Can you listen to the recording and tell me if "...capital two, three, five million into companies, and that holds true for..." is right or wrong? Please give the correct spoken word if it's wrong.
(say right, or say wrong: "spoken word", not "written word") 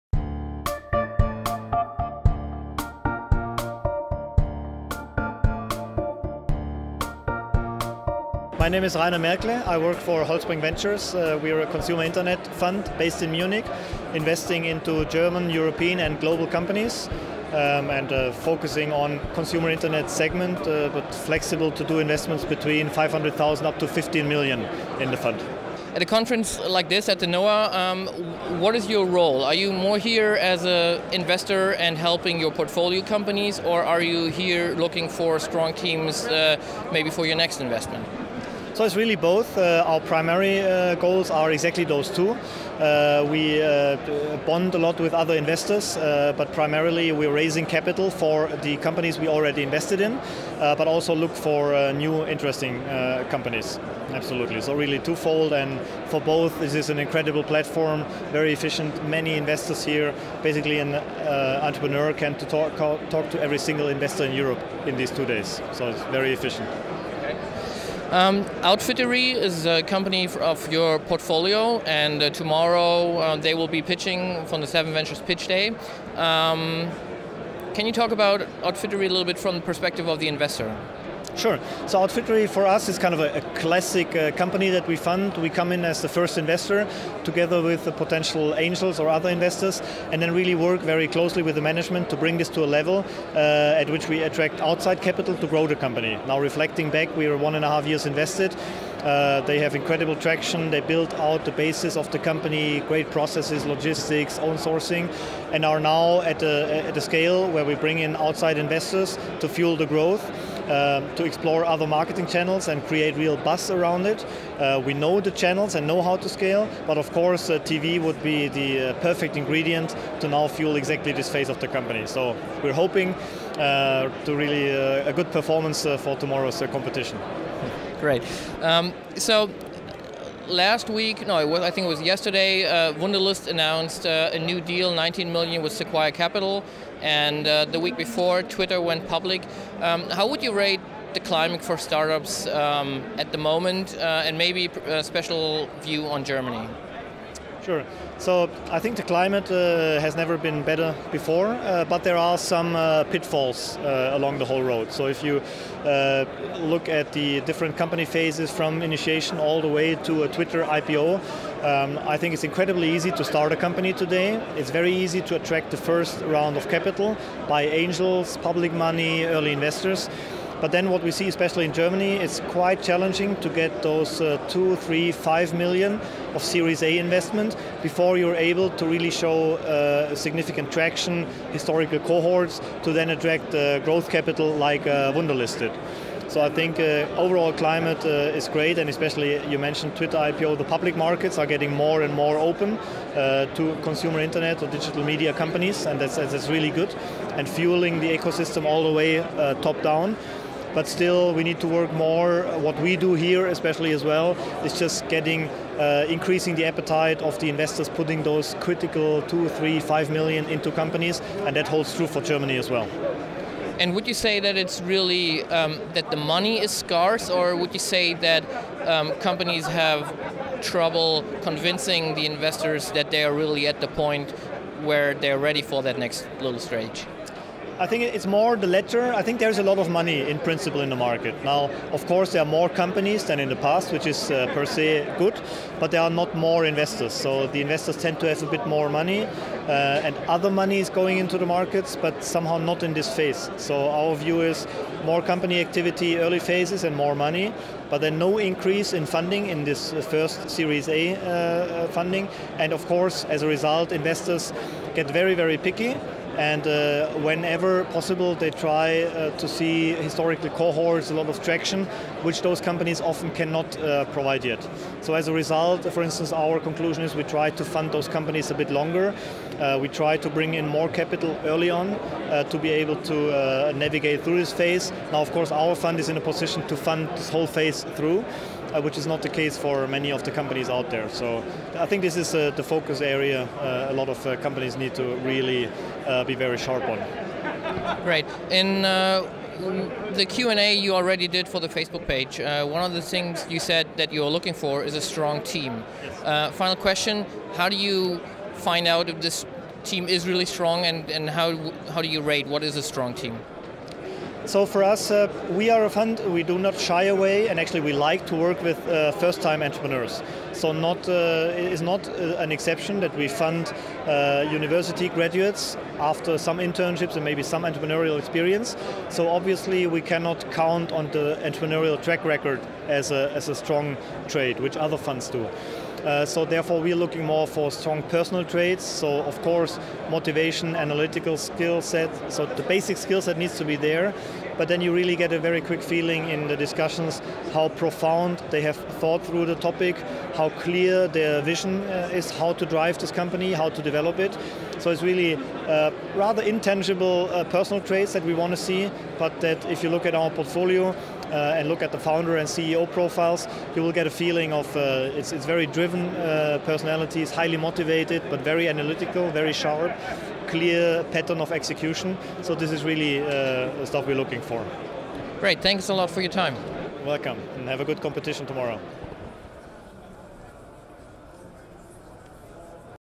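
wrong: "critical", not "capital".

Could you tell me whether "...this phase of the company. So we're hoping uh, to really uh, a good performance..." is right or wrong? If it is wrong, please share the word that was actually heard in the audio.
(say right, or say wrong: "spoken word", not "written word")
right.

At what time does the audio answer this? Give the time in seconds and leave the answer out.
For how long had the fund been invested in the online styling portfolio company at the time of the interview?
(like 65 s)
97 s.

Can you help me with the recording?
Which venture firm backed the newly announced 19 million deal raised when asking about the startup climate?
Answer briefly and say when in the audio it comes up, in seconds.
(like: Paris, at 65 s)
Sequoia Capital, at 135 s.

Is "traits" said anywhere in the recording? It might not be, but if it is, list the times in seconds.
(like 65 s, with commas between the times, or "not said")
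328 s, 347 s.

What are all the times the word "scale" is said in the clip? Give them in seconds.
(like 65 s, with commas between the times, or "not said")
107 s, 116 s.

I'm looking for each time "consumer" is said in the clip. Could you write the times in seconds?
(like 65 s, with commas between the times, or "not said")
11 s, 19 s, 193 s.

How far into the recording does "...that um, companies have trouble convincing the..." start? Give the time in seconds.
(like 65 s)
218 s.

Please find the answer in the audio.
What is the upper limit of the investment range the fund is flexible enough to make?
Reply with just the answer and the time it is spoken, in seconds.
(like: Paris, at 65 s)
15 million, at 23 s.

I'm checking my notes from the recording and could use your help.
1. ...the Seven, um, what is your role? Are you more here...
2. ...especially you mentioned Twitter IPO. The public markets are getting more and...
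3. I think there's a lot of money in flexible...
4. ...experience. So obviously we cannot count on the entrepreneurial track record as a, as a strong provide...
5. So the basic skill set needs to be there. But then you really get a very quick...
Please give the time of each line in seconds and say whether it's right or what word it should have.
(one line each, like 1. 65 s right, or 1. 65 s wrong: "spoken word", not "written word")
1. 27 s wrong: "Noah", not "Seven"
2. 188 s right
3. 229 s wrong: "principle", not "flexible"
4. 318 s wrong: "trade", not "provide"
5. 332 s right.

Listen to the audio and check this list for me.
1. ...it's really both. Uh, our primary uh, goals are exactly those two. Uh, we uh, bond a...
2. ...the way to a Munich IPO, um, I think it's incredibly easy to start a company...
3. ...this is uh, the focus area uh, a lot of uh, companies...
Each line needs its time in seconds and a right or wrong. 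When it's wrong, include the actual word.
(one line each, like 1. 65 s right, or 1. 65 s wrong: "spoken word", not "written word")
1. 38 s right
2. 159 s wrong: "Twitter", not "Munich"
3. 282 s right.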